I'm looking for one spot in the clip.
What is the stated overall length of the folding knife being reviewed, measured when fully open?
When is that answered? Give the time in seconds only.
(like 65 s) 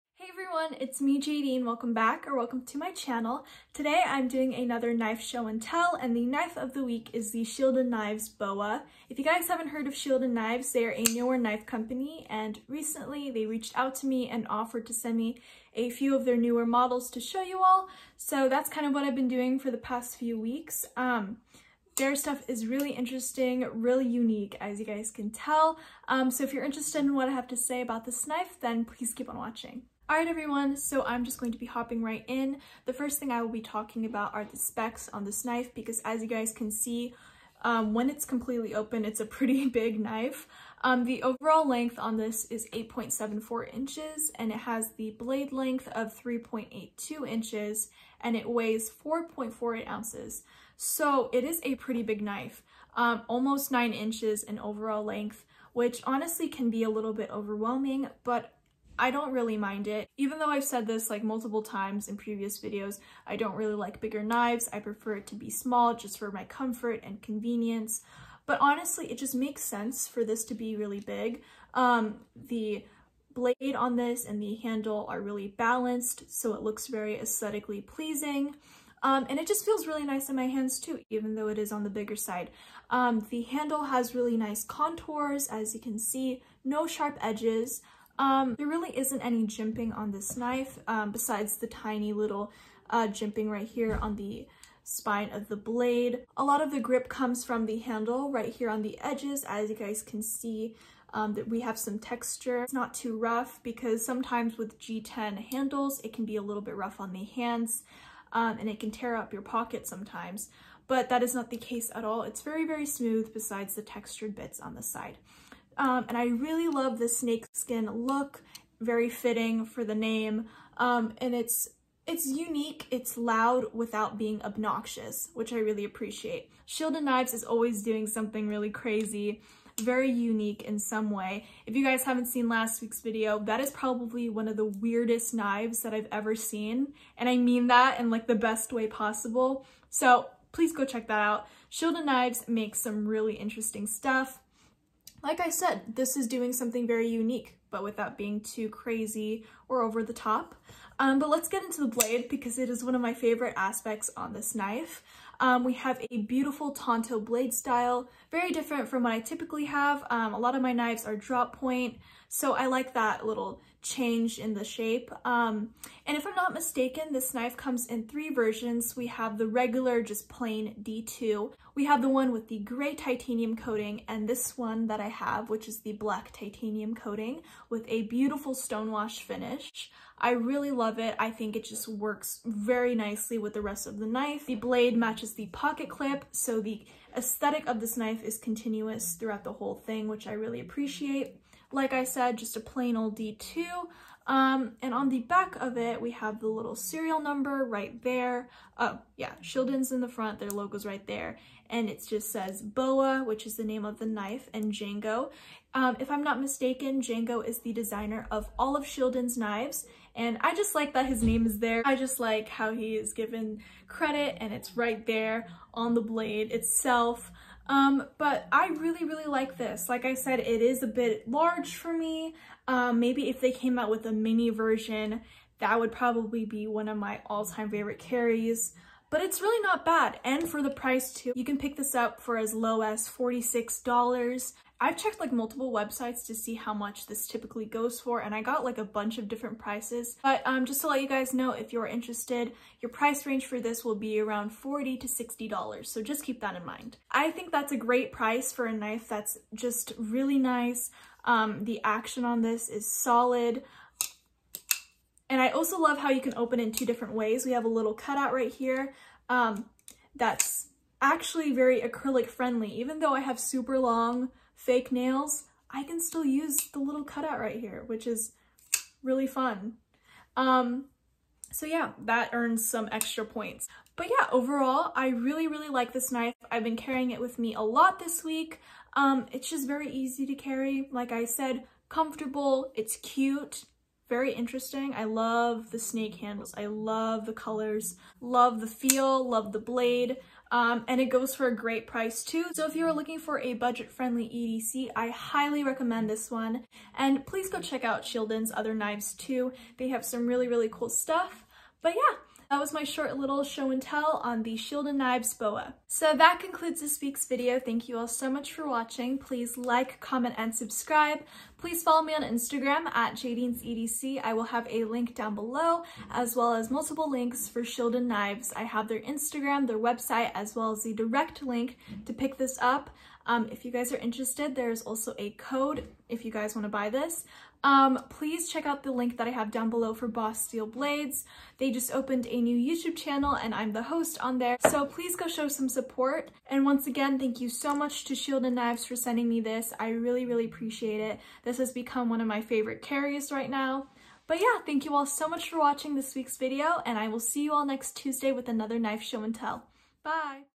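42 s.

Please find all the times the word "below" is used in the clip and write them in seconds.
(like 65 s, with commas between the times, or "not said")
315 s, 329 s.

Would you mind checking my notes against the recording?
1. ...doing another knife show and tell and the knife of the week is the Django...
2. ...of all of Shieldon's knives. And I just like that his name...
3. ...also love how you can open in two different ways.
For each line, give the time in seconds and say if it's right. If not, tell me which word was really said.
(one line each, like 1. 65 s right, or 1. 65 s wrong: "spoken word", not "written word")
1. 4 s wrong: "Shield", not "Django"
2. 208 s right
3. 255 s right.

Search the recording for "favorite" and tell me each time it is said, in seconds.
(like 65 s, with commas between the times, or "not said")
153 s, 227 s, 342 s.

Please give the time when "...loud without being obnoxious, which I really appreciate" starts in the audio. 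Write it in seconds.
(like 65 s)
123 s.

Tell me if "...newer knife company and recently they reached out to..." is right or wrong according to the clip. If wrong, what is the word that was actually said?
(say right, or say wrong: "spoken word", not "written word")
right.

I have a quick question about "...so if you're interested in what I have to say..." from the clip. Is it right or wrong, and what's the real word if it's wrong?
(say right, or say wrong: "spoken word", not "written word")
right.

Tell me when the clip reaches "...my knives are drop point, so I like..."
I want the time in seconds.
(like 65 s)
160 s.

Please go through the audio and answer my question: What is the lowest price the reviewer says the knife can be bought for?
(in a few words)
$46.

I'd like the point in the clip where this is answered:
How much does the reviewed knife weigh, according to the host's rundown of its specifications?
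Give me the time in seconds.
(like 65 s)
48 s.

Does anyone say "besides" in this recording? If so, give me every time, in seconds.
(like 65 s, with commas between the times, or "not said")
91 s, 113 s.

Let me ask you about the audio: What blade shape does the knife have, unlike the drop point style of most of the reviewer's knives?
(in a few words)
Tonto.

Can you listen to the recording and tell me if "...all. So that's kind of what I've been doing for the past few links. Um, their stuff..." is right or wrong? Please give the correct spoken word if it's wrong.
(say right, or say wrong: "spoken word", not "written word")
wrong: "weeks", not "links".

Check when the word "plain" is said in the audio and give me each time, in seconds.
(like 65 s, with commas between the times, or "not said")
170 s, 192 s.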